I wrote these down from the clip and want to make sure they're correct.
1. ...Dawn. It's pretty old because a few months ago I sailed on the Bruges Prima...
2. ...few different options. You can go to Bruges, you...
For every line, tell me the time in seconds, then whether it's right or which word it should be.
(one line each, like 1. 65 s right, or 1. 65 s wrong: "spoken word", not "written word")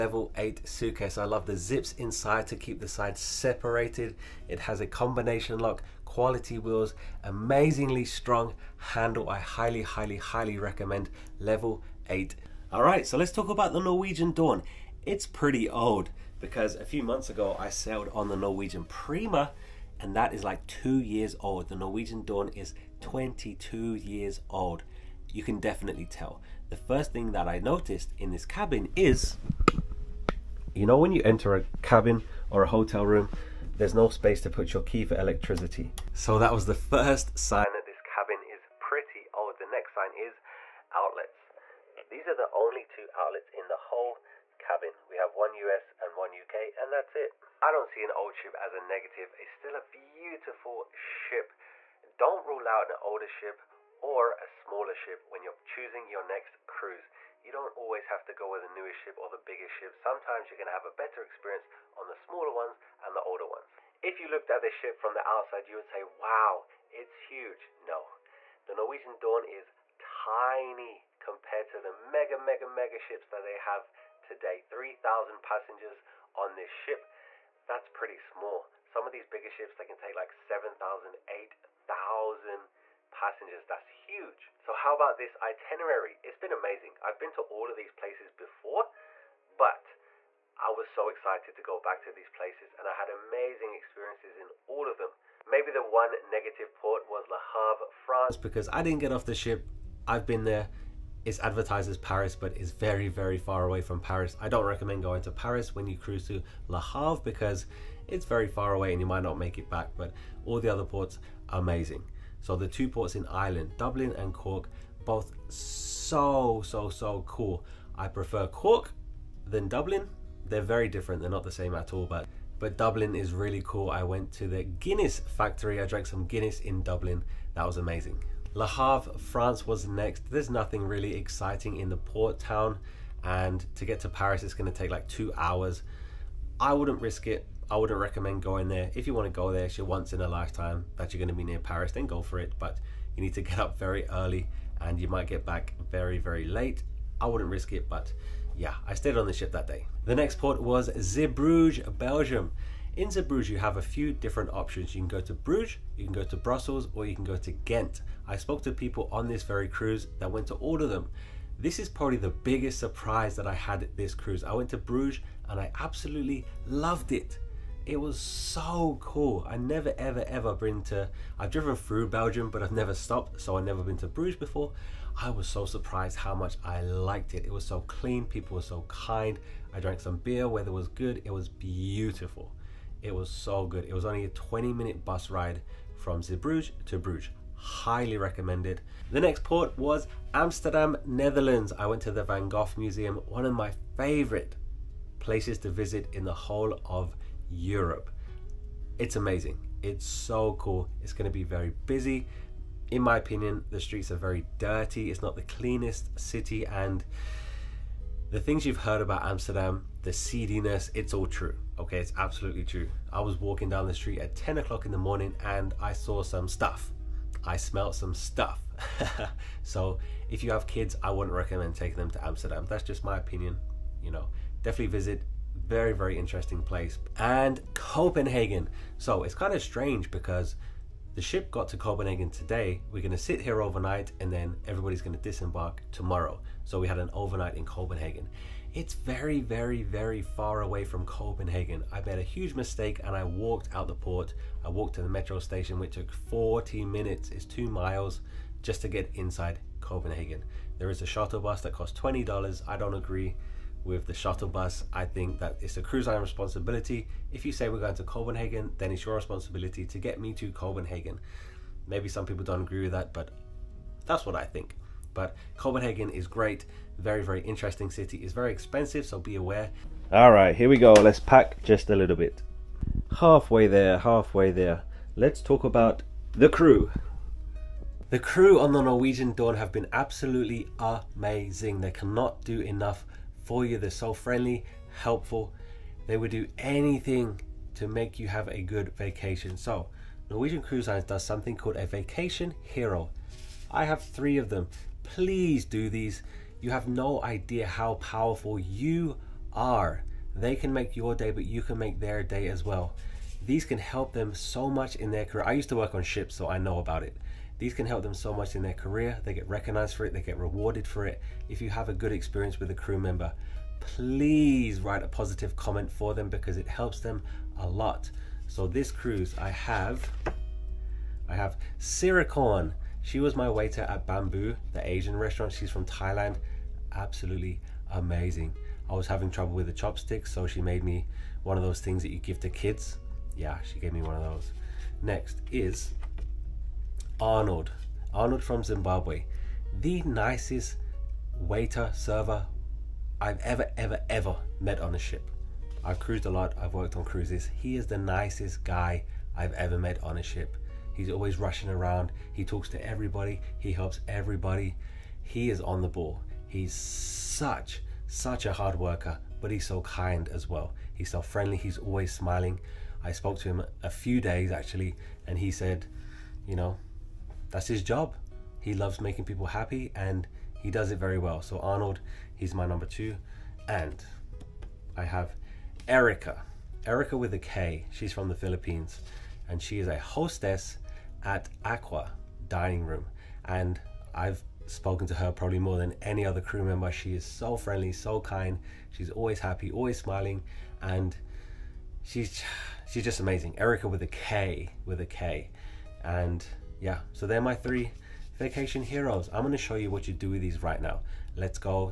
1. 14 s wrong: "Norwegian", not "Bruges"
2. 153 s right.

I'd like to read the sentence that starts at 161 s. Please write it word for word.
This is probably the biggest surprise that I had this cruise.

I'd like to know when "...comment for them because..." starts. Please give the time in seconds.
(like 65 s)
315 s.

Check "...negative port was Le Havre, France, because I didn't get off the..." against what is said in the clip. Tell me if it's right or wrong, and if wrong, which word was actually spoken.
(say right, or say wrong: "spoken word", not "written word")
right.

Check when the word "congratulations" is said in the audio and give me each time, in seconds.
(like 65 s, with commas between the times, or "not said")
not said.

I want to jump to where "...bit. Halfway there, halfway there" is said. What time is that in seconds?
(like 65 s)
272 s.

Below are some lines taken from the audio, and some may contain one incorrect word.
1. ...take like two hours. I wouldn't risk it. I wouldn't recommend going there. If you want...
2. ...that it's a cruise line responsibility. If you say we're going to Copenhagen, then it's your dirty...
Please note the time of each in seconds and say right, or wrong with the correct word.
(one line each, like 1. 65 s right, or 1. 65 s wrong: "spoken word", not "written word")
1. 134 s right
2. 255 s wrong: "responsibility", not "dirty".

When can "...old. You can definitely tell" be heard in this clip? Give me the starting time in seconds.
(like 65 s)
24 s.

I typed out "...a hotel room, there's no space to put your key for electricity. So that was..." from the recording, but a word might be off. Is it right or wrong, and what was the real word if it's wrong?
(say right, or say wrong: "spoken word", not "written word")
right.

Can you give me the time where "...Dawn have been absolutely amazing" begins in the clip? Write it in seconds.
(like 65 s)
279 s.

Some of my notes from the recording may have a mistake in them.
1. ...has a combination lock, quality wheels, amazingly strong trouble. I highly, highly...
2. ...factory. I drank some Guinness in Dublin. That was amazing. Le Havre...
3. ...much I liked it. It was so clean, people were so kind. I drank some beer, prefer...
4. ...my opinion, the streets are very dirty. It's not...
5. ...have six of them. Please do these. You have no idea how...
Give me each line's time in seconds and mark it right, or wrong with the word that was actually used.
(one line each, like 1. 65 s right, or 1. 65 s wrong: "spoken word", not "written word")
1. 4 s wrong: "handle", not "trouble"
2. 125 s right
3. 176 s wrong: "weather", not "prefer"
4. 203 s right
5. 293 s wrong: "three", not "six".